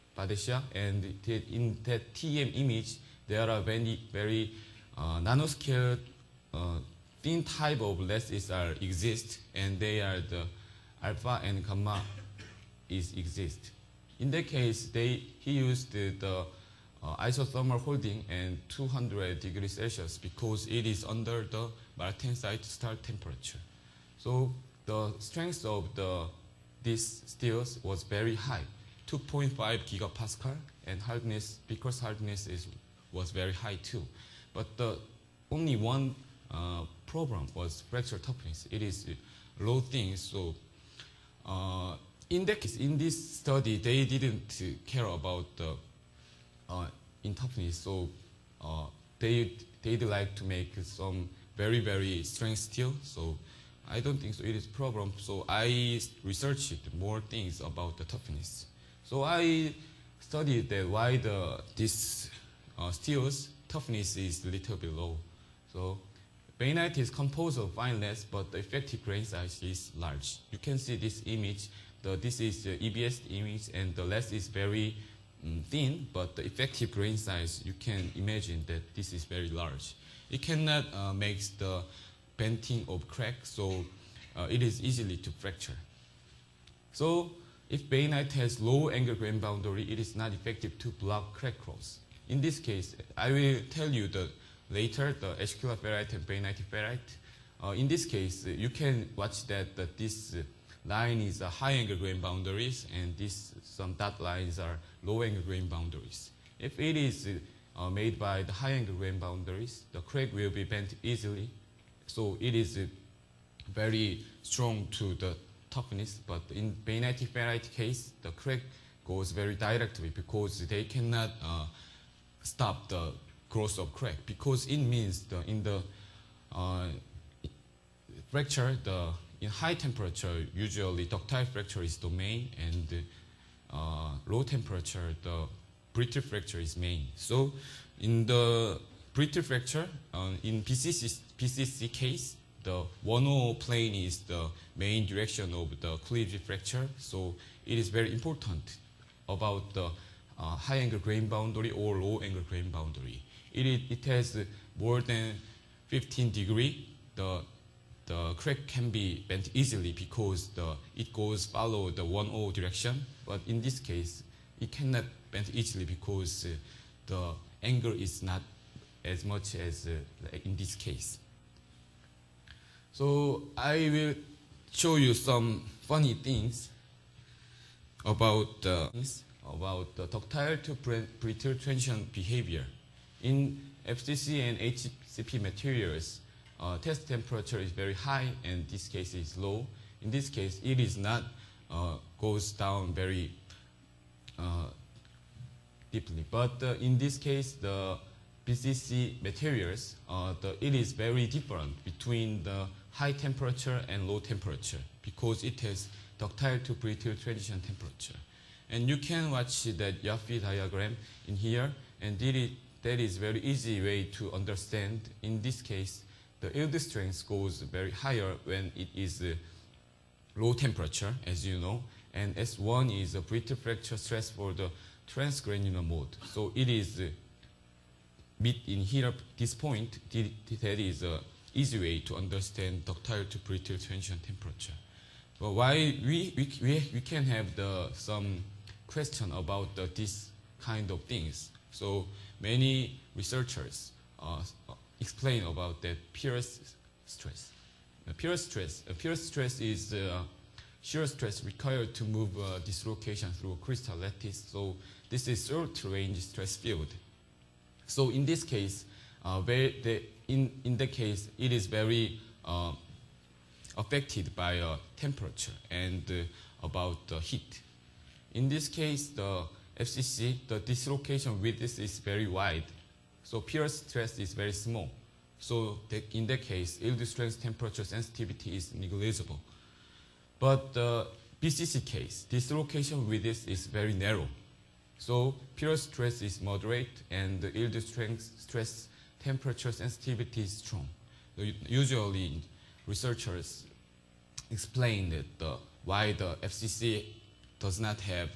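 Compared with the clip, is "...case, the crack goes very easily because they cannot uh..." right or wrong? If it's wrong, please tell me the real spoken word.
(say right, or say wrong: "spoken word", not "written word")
wrong: "directly", not "easily".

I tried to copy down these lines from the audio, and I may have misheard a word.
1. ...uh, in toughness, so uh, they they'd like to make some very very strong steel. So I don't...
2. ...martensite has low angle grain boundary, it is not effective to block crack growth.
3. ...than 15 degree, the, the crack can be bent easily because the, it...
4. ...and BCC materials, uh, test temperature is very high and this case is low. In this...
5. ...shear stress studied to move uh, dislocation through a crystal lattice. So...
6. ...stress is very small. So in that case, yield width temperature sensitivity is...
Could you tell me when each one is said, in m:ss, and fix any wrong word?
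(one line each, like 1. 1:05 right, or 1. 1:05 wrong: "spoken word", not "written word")
1. 0:46 right
2. 1:27 wrong: "bainite", not "martensite"
3. 2:35 right
4. 3:04 wrong: "HCP", not "BCC"
5. 4:10 wrong: "required", not "studied"
6. 4:33 wrong: "strength", not "width".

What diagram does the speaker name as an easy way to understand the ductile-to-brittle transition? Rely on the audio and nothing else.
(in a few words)
Yoffe diagram.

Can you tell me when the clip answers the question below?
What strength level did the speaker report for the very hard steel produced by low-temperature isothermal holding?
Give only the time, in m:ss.
0:29.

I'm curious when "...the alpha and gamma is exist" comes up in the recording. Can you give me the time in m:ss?
0:10.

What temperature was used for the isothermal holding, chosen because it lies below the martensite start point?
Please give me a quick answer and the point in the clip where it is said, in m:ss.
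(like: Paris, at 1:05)
200 degrees Celsius, at 0:18.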